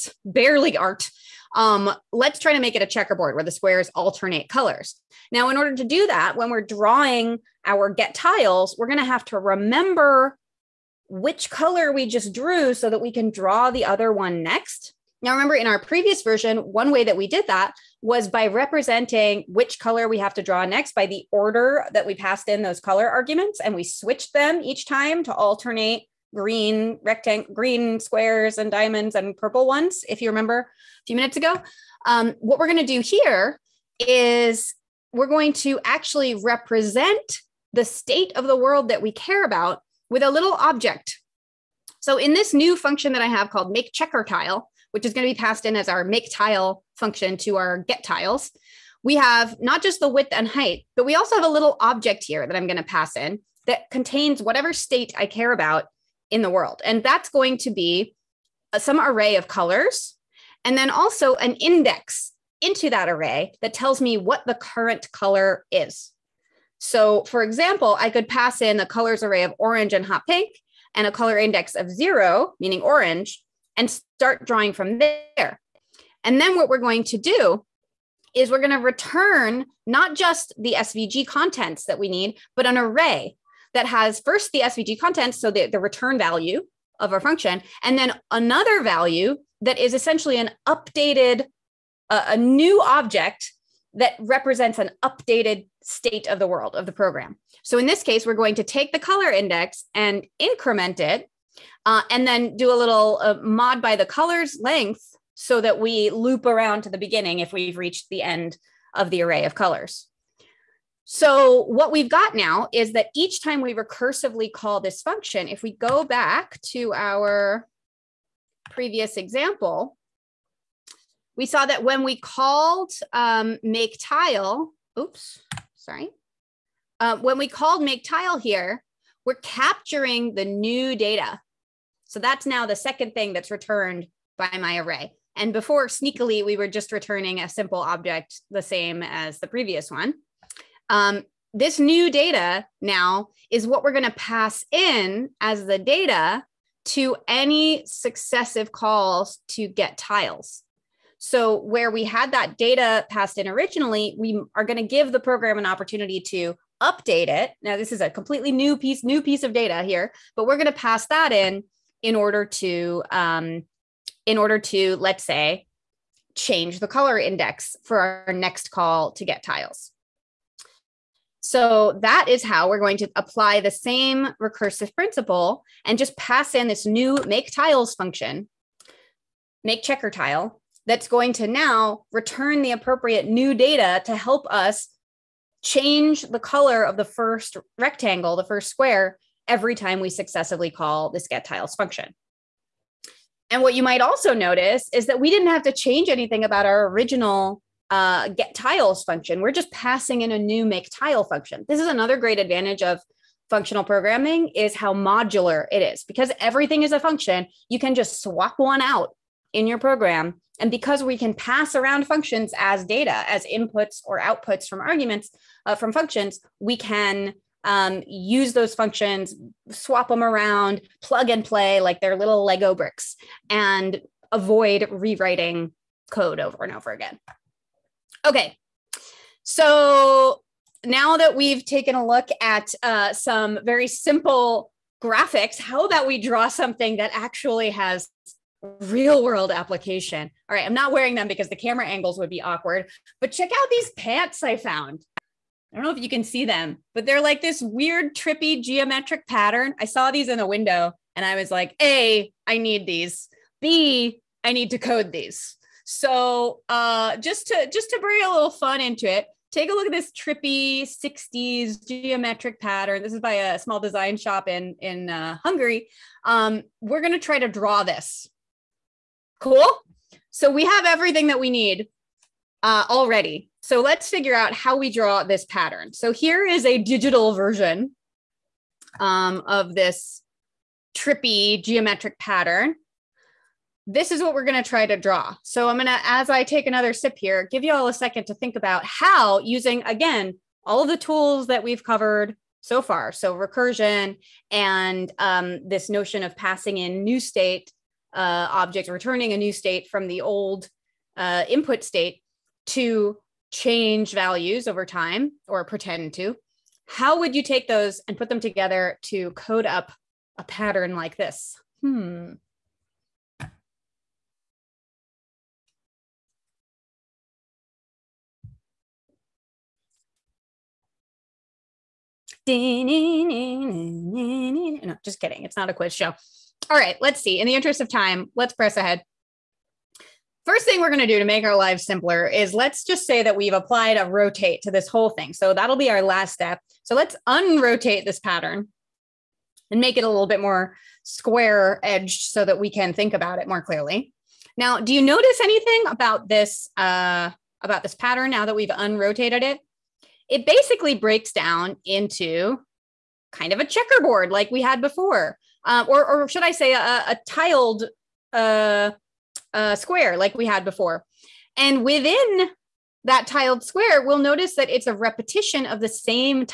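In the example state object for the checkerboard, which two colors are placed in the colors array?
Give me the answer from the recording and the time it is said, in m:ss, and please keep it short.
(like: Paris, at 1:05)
orange and hot pink, at 1:09.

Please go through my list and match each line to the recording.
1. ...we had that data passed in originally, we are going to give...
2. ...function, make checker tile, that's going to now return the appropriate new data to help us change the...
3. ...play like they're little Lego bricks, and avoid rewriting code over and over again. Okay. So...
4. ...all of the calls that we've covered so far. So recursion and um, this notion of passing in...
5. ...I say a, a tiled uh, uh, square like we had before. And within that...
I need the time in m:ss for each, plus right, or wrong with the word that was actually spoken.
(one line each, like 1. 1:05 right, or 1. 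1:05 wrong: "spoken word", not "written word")
1. 2:31 right
2. 2:57 right
3. 3:41 right
4. 4:50 wrong: "tools", not "calls"
5. 5:56 right.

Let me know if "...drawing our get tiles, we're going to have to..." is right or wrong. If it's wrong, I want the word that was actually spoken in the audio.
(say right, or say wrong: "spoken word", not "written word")
right.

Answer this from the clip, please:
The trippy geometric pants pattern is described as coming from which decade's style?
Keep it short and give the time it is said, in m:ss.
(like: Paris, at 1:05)
60s, at 4:20.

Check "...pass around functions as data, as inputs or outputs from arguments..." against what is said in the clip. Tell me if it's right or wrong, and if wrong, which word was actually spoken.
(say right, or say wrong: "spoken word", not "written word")
right.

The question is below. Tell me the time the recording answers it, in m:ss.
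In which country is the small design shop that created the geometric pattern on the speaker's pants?
4:25.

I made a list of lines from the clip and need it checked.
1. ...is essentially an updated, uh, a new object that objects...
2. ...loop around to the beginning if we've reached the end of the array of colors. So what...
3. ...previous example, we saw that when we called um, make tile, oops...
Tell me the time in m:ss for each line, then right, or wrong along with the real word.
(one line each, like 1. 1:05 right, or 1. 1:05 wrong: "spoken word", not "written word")
1. 1:29 wrong: "represents", not "objects"
2. 1:46 right
3. 1:58 right.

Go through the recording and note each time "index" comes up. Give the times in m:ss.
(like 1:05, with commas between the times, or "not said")
1:01, 1:11, 1:39, 2:47.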